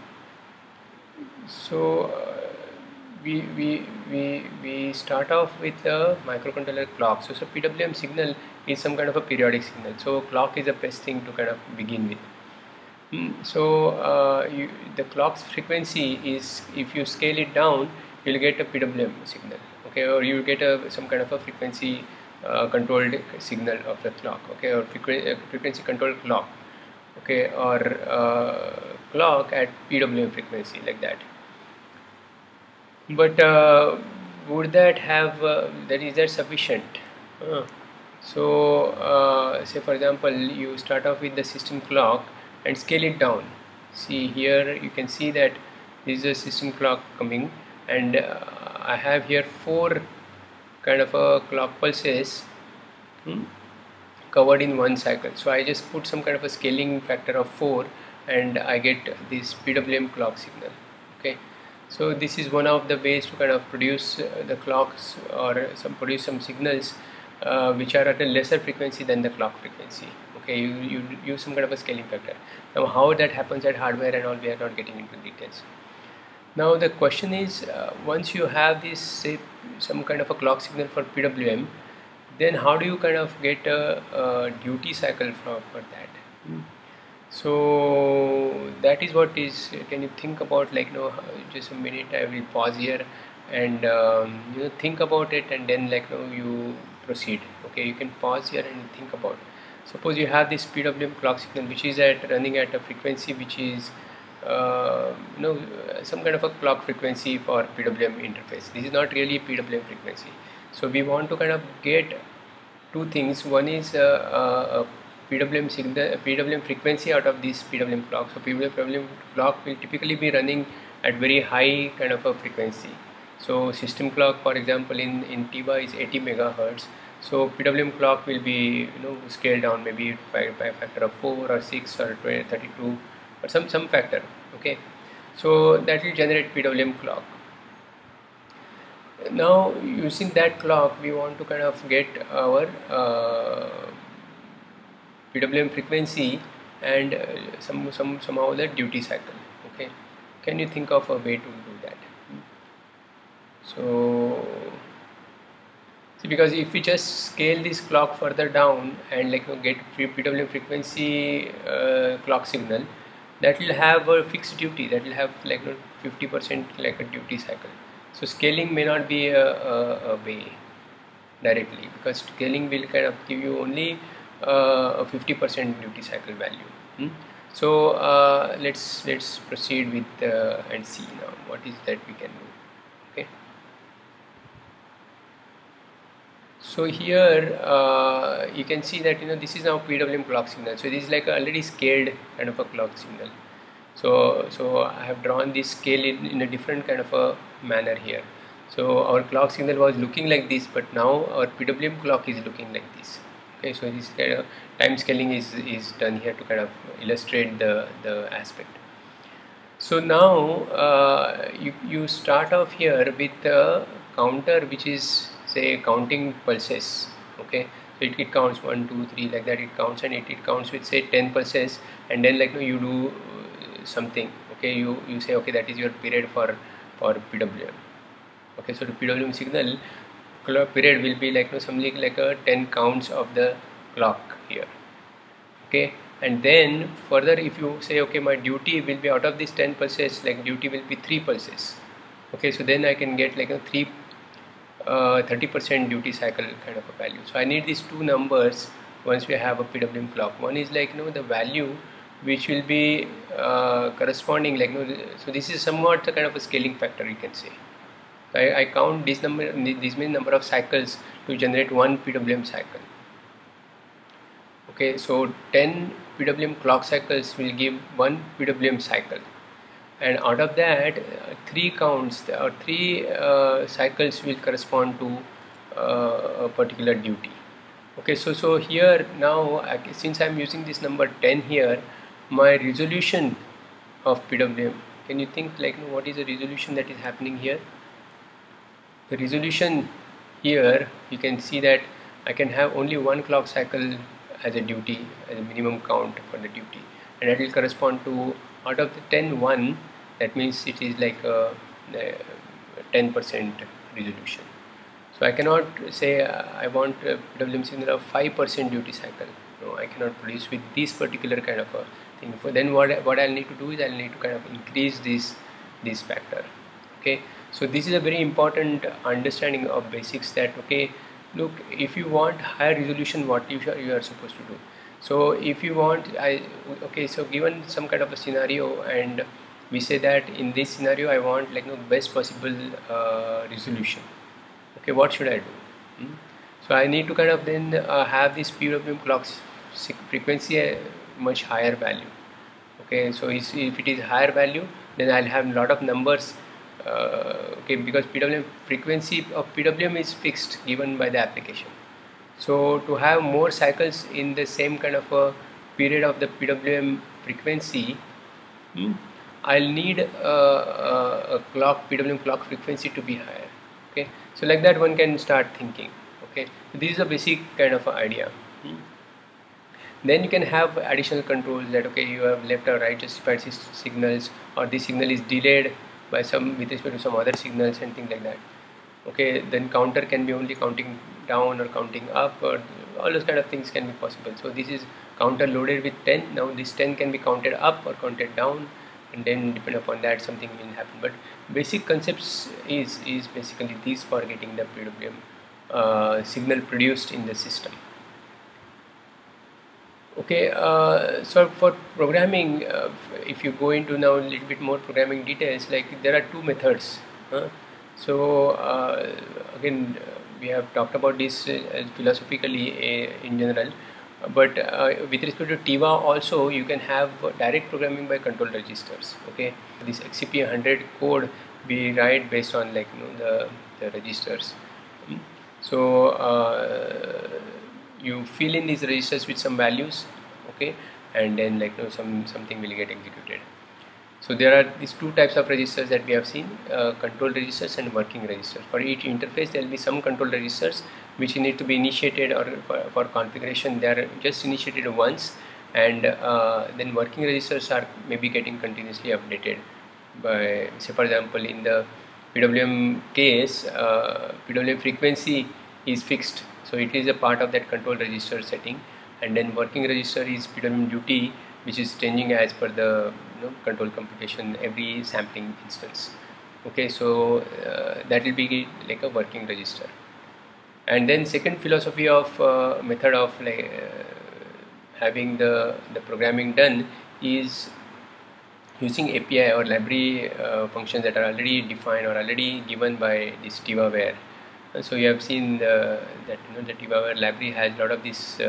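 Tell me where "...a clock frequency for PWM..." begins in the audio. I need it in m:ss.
1:46.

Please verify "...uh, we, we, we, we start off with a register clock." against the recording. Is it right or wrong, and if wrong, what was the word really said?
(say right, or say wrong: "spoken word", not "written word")
wrong: "microcontroller", not "register".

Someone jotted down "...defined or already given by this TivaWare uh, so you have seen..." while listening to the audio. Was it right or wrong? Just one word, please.
right.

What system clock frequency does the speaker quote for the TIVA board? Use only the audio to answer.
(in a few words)
80 megahertz.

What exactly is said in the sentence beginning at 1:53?
a uh, PWM signal, PWM frequency out of this PWM clock.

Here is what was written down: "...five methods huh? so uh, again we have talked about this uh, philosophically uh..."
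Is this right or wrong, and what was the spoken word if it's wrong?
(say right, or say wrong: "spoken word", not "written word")
wrong: "two", not "five".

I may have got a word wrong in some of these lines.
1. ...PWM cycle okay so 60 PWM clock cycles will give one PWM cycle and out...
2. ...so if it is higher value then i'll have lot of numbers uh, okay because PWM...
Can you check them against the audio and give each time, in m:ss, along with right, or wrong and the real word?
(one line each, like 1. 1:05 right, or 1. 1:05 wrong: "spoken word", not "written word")
1. 4:21 wrong: "10", not "60"
2. 5:43 right.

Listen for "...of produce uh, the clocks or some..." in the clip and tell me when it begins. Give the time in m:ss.
1:03.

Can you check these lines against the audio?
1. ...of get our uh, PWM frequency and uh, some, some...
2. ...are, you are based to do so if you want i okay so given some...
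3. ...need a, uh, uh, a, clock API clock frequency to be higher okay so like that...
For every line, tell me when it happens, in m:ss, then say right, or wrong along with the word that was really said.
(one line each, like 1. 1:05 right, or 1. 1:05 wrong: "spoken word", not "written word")
1. 2:21 right
2. 5:23 wrong: "supposed", not "based"
3. 5:59 wrong: "PWM", not "API".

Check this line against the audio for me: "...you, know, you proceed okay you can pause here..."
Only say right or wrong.
right.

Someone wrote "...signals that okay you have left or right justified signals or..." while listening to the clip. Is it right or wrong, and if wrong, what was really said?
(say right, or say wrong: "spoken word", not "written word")
wrong: "controls", not "signals".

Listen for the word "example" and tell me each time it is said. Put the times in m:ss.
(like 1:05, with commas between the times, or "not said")
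0:39, 2:04, 7:31.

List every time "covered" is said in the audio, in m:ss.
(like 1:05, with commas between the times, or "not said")
0:54.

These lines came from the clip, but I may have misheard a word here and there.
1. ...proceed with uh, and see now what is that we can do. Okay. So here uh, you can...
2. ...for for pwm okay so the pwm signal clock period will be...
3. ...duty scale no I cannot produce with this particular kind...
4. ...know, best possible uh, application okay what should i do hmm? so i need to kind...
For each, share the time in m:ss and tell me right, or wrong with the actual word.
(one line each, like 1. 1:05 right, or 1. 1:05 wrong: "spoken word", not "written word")
1. 2:59 right
2. 3:46 right
3. 5:08 wrong: "cycle", not "scale"
4. 5:31 wrong: "resolution", not "application".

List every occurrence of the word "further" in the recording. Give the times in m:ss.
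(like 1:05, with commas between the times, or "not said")
2:38, 3:57.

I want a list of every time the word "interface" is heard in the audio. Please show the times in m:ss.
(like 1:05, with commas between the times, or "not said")
1:48, 7:19.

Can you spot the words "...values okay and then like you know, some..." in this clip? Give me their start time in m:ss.
7:09.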